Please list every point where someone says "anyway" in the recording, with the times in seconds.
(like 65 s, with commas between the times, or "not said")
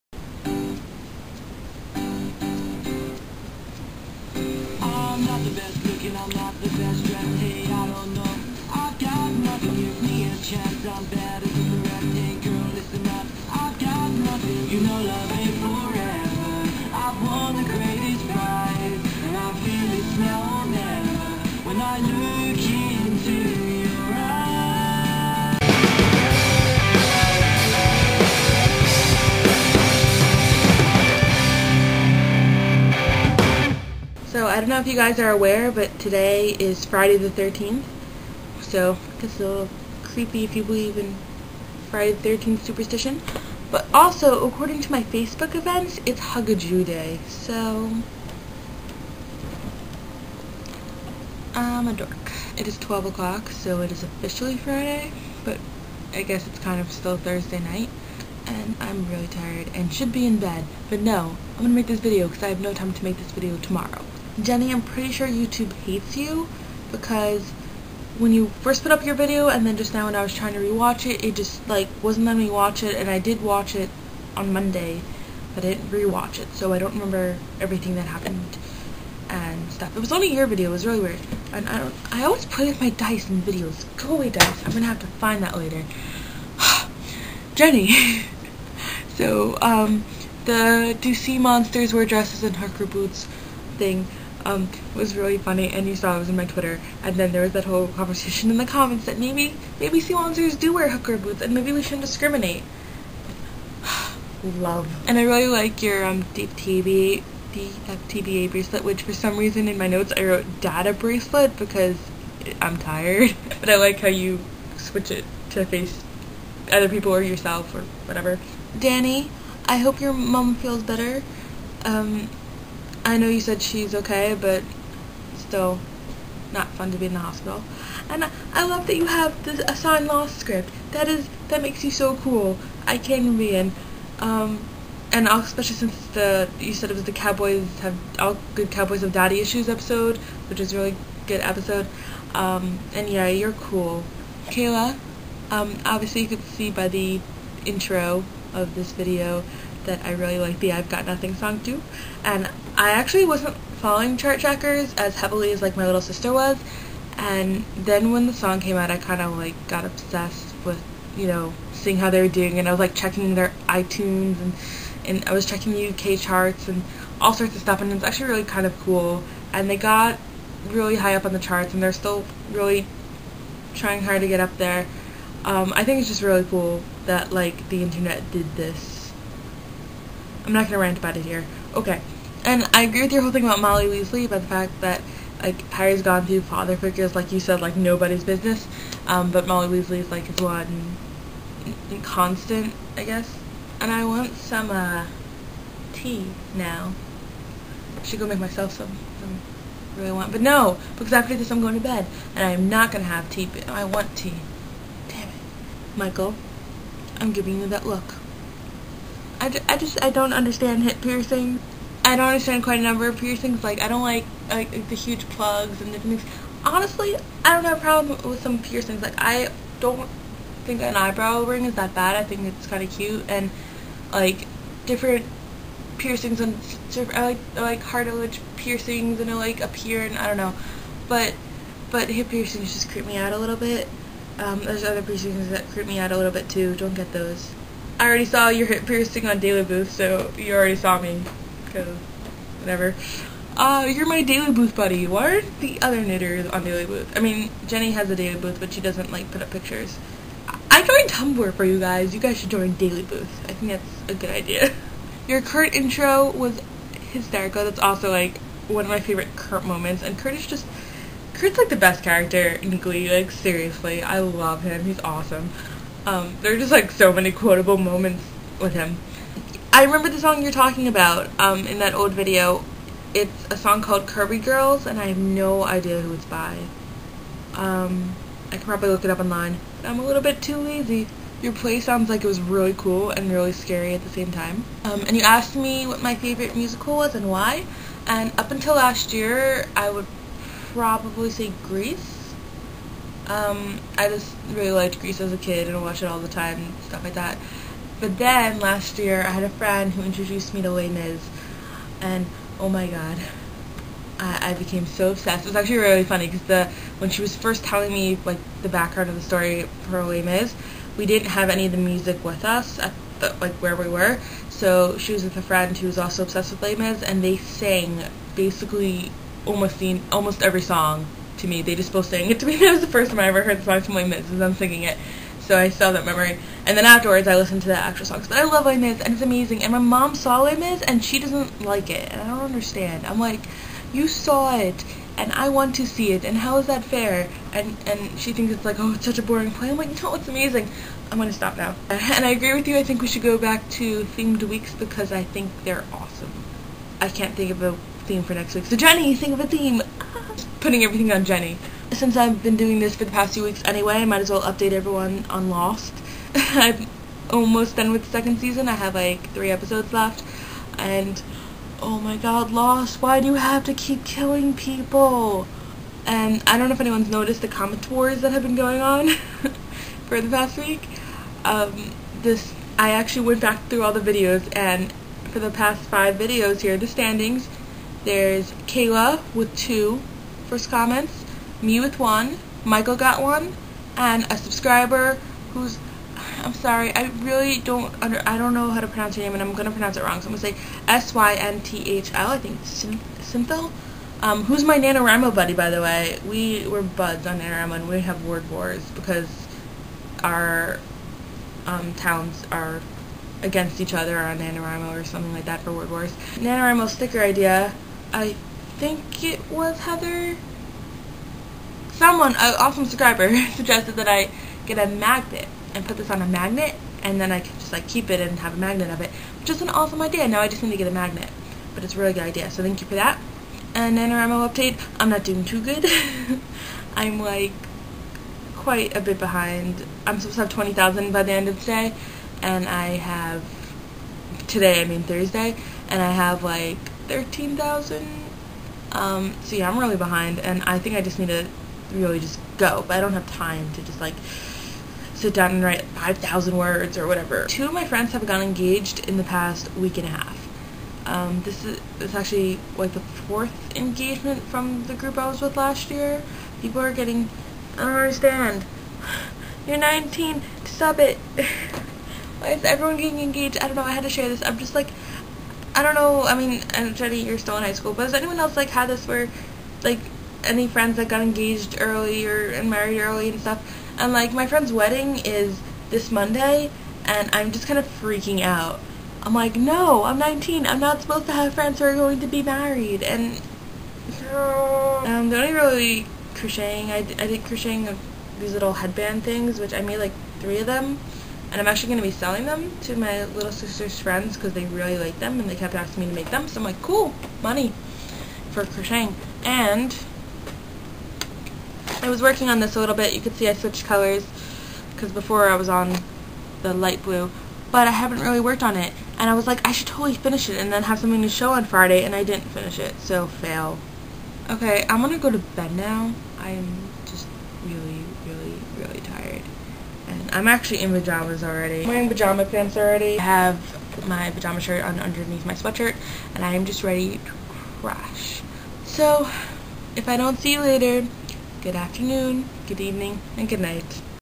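353 s.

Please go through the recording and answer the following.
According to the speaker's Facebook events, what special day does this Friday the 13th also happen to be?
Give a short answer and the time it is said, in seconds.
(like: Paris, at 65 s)
Hugajoo Day, at 46 s.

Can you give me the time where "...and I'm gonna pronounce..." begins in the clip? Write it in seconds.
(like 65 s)
389 s.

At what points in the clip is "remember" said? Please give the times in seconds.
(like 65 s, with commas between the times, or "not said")
76 s, 269 s.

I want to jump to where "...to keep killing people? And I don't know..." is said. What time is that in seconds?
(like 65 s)
363 s.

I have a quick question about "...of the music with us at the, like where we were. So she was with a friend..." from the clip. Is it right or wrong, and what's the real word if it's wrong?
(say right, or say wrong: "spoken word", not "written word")
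right.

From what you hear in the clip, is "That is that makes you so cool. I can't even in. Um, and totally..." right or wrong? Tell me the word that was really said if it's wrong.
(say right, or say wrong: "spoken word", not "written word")
wrong: "especially", not "totally".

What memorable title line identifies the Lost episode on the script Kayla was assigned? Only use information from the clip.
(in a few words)
Cowboys have daddy issues.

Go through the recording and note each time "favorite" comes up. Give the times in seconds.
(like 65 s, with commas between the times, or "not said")
258 s, 286 s.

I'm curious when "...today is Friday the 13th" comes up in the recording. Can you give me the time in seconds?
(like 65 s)
35 s.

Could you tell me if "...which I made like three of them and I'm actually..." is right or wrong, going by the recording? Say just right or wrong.
right.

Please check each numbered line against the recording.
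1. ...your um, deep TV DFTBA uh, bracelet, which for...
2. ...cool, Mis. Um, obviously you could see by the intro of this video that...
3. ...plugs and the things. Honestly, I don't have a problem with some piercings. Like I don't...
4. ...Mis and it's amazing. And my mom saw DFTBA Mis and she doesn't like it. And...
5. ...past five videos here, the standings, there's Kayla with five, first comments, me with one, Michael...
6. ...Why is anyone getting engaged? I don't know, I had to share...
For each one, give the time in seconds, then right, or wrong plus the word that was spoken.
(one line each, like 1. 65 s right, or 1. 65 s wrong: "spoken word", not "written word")
1. 105 s right
2. 143 s wrong: "Kayla", not "Mis"
3. 215 s right
4. 328 s wrong: "Les", not "DFTBA"
5. 375 s wrong: "two", not "five"
6. 462 s wrong: "everyone", not "anyone".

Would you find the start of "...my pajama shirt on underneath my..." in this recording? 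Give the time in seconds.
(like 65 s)
524 s.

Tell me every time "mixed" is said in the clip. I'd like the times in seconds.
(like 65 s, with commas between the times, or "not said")
not said.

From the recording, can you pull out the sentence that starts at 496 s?
So I'm like, cool, money for crocheting.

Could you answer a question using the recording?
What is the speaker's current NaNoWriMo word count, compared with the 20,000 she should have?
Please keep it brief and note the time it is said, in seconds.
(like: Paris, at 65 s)
13,000, at 437 s.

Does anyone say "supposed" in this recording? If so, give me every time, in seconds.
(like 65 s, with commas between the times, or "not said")
430 s, 481 s.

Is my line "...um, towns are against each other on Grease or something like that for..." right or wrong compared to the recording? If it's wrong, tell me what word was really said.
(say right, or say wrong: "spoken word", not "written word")
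wrong: "NaNoWriMo", not "Grease".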